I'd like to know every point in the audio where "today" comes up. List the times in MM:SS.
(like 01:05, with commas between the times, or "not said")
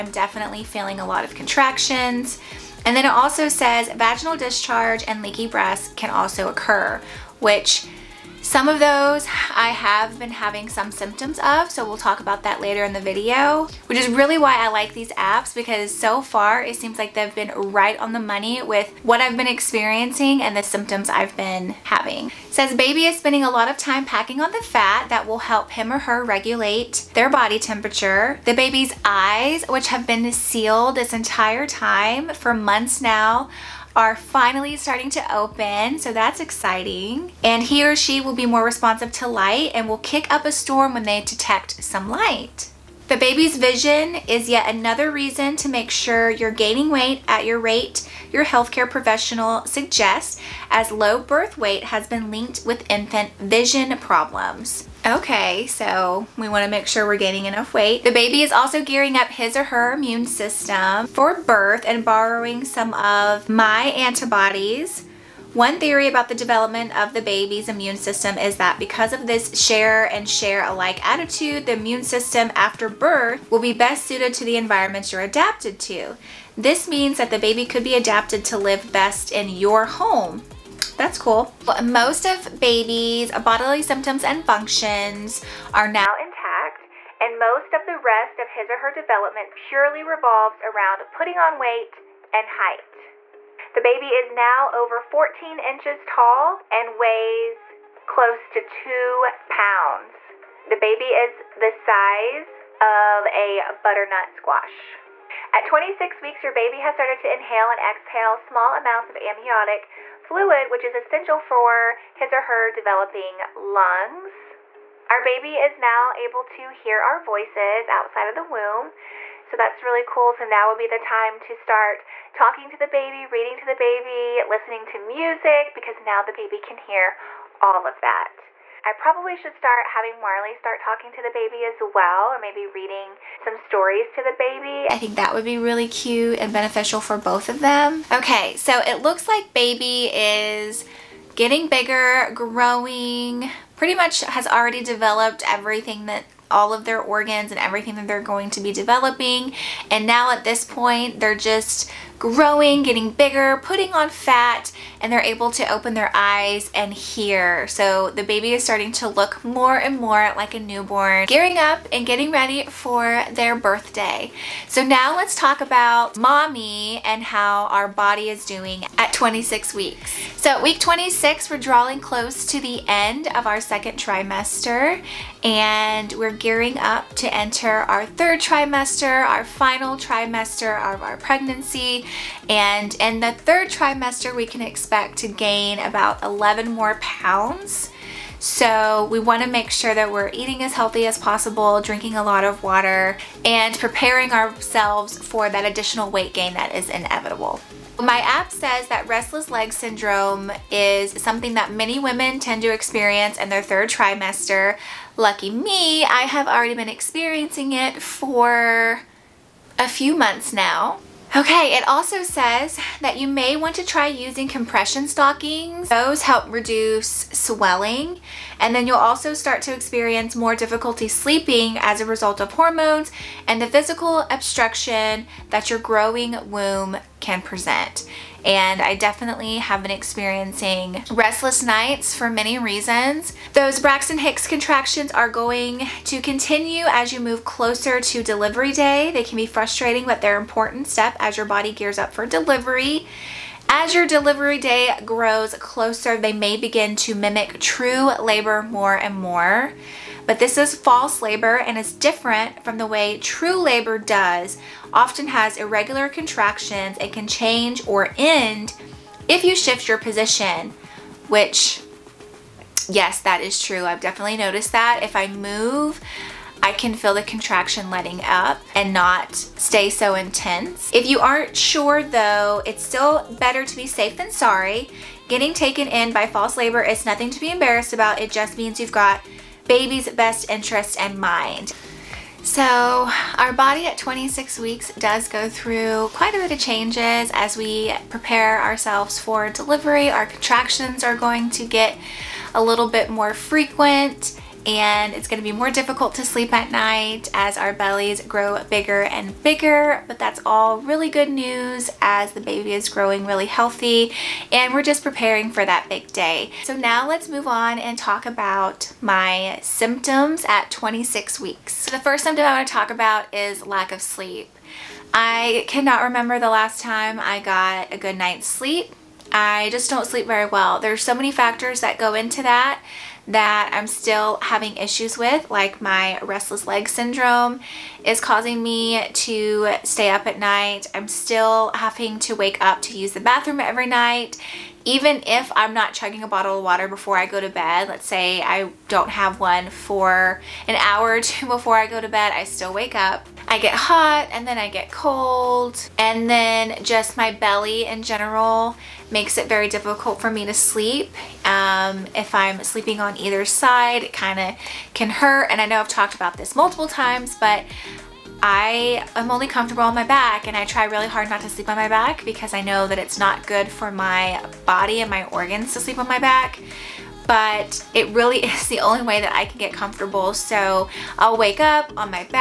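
not said.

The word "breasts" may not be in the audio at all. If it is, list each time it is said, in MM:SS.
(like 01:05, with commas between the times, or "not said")
00:05.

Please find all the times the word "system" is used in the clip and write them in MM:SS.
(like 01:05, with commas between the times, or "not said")
01:00, 01:07, 01:12.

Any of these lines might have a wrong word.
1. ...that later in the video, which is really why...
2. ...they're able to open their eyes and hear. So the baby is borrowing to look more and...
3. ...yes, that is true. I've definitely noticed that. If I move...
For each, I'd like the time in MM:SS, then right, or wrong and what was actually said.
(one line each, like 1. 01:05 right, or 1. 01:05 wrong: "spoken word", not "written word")
1. 00:12 right
2. 02:35 wrong: "starting", not "borrowing"
3. 04:22 right.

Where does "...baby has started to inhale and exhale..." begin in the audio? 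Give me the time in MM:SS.
01:46.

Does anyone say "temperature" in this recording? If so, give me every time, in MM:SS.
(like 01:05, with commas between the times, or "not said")
00:27.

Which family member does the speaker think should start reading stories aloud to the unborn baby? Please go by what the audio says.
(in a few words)
Marley.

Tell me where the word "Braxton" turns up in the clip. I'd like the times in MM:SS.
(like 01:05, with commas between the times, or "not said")
03:53.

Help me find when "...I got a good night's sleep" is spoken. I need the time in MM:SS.
05:17.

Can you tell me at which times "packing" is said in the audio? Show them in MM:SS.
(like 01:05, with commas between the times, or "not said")
00:24.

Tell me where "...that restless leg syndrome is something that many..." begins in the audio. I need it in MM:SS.
03:18.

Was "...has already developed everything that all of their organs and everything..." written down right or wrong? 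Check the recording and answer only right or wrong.
right.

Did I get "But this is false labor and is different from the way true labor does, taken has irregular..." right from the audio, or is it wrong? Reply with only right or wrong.
wrong.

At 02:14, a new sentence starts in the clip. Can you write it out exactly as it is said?
I think that would be really cute and beneficial for both of them.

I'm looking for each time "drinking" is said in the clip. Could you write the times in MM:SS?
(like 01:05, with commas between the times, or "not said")
03:11.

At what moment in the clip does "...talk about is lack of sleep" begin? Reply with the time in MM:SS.
05:12.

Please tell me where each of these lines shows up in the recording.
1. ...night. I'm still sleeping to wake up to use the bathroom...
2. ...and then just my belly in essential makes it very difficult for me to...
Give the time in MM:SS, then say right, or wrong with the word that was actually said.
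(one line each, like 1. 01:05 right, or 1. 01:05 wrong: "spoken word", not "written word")
1. 05:30 wrong: "having", not "sleeping"
2. 05:45 wrong: "general", not "essential".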